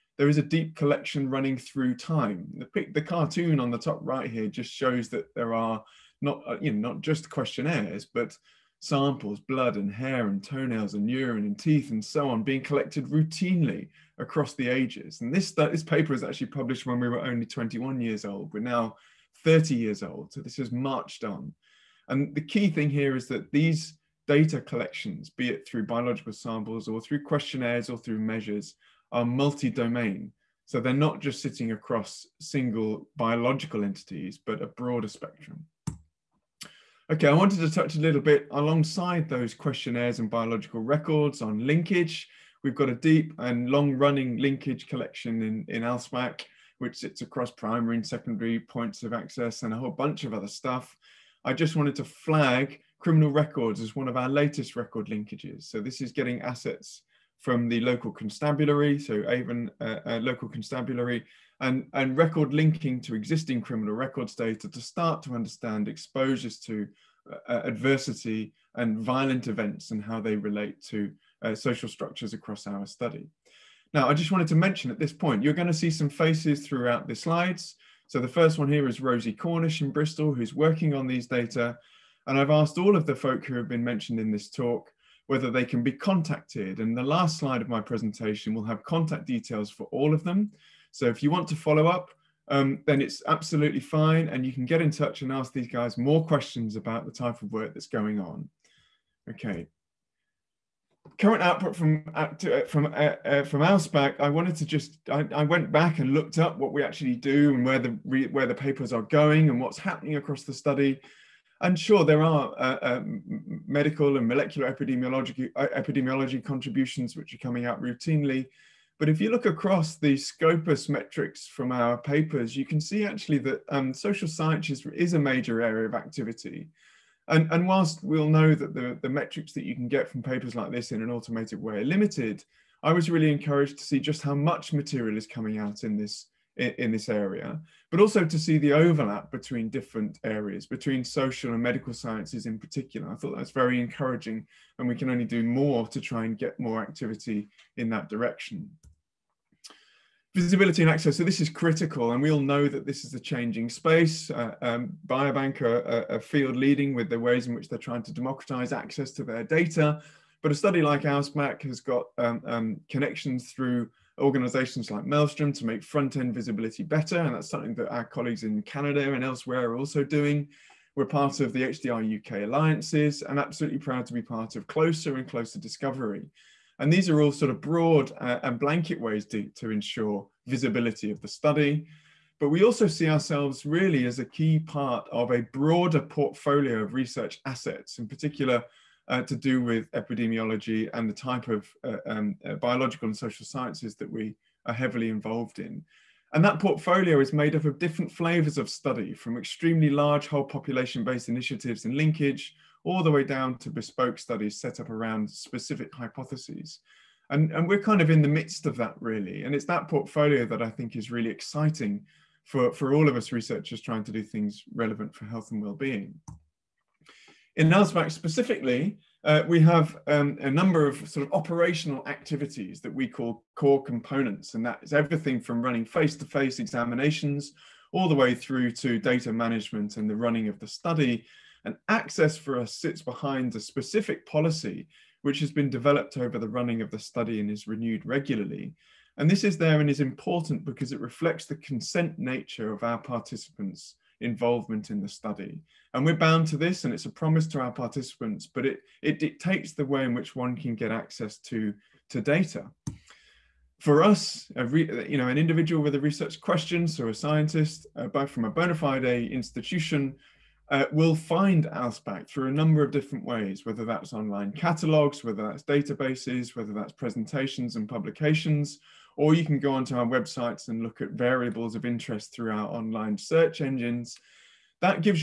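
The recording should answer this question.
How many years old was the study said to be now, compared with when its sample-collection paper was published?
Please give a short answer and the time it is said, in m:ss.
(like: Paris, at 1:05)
30, at 0:19.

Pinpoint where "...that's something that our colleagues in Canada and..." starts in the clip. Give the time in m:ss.
2:47.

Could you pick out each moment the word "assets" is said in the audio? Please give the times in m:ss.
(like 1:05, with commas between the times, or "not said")
0:56, 3:07.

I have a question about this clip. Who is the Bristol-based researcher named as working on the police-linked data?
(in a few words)
Rosie Cornish.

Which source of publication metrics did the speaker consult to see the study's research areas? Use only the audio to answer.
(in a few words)
Scopus.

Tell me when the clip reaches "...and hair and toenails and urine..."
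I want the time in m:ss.
0:09.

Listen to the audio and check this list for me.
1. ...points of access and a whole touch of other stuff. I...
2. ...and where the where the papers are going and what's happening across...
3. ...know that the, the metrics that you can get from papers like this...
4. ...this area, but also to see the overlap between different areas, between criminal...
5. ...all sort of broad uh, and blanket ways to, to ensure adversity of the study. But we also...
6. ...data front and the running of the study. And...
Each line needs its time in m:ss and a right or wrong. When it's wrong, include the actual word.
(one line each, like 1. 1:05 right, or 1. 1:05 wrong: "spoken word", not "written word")
1. 0:48 wrong: "bunch", not "touch"
2. 1:47 right
3. 2:08 right
4. 2:16 wrong: "social", not "criminal"
5. 2:57 wrong: "visibility", not "adversity"
6. 3:48 wrong: "management", not "front".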